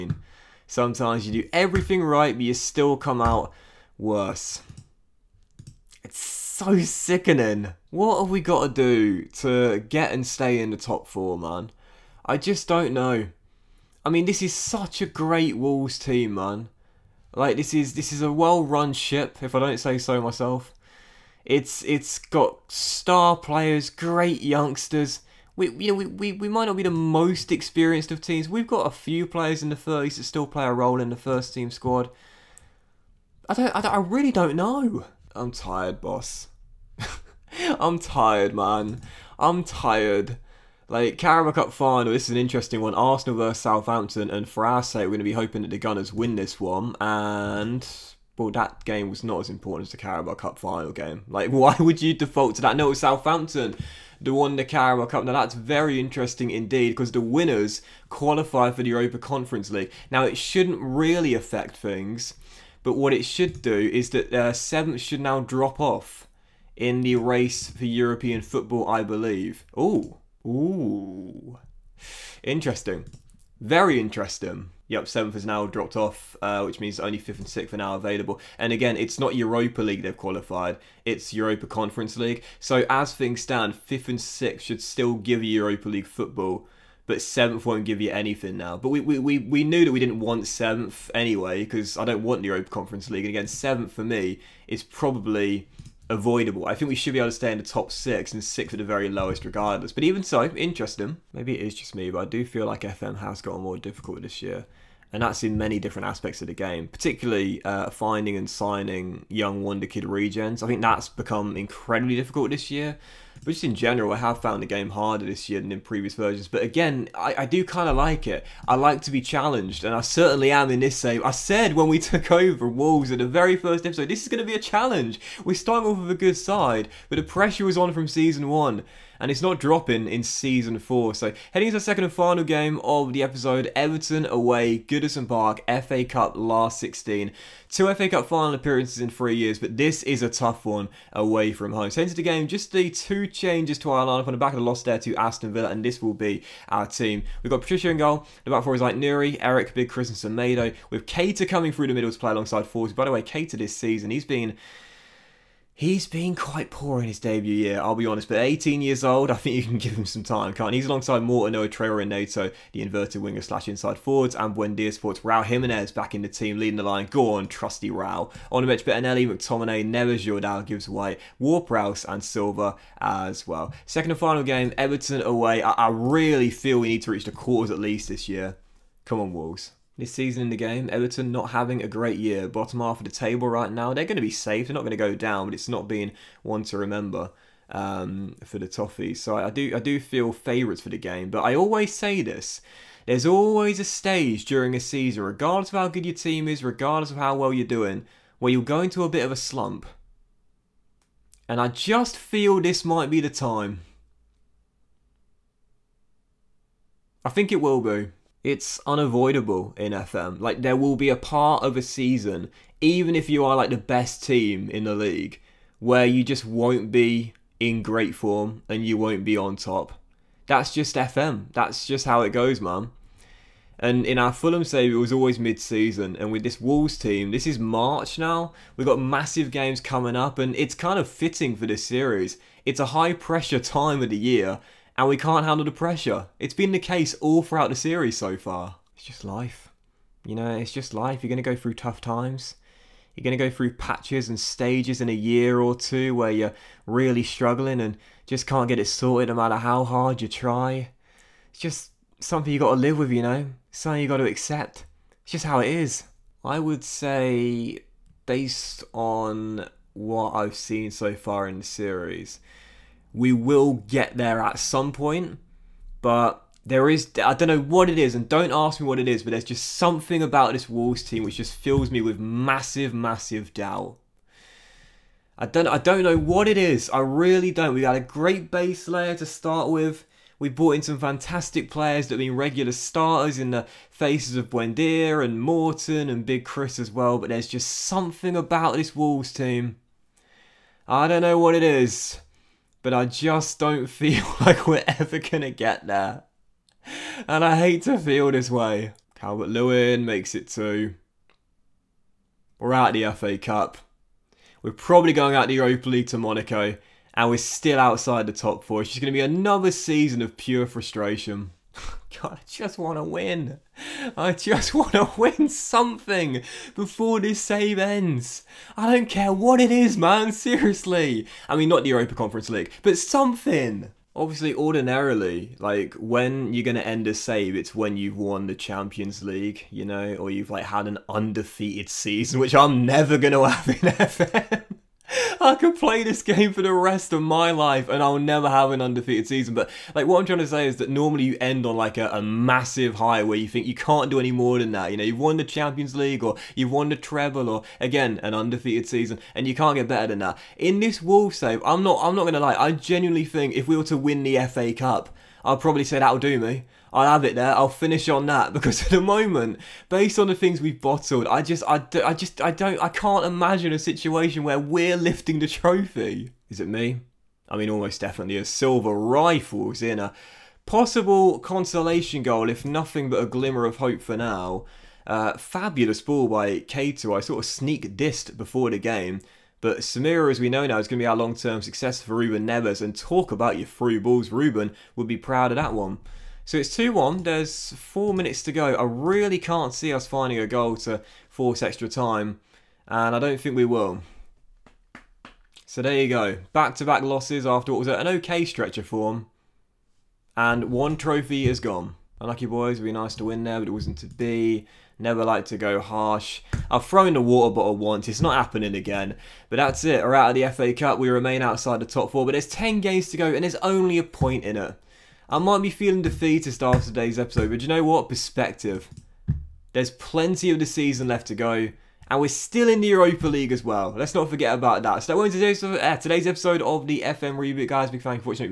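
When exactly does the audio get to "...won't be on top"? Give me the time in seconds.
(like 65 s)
218 s.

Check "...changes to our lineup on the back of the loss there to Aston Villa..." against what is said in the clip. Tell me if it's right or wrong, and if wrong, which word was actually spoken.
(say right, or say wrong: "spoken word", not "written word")
right.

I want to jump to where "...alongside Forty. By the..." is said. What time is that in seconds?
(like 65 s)
152 s.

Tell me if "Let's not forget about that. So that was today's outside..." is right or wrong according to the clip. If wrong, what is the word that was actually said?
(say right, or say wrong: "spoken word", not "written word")
wrong: "episode", not "outside".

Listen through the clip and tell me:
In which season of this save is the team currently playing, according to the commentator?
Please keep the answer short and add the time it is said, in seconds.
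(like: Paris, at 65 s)
Season four, at 130 s.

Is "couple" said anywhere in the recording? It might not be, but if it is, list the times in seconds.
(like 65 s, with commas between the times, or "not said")
not said.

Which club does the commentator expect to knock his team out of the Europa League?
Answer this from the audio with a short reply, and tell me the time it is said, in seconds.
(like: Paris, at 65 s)
Monaco, at 306 s.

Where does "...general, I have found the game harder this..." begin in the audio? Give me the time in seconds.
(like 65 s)
113 s.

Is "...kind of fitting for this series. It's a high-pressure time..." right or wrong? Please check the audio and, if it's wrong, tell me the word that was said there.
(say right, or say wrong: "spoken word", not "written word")
right.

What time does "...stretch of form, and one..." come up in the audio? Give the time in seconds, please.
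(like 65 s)
398 s.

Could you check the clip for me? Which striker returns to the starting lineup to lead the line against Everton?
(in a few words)
Raul Jimenez.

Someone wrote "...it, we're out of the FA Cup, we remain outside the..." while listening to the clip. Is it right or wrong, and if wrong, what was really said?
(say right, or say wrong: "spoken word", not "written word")
right.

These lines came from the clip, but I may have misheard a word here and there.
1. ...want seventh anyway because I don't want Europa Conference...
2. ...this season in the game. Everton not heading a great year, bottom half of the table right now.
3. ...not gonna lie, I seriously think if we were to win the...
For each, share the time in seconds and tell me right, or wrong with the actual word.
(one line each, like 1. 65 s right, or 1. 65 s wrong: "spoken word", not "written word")
1. 90 s right
2. 180 s wrong: "having", not "heading"
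3. 352 s wrong: "genuinely", not "seriously".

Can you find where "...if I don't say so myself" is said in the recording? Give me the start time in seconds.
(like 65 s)
19 s.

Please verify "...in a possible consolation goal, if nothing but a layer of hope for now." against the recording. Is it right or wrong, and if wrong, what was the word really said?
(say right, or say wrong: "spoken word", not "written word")
wrong: "glimmer", not "layer".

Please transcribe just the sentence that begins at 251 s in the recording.
It's just something you got to live with, you know?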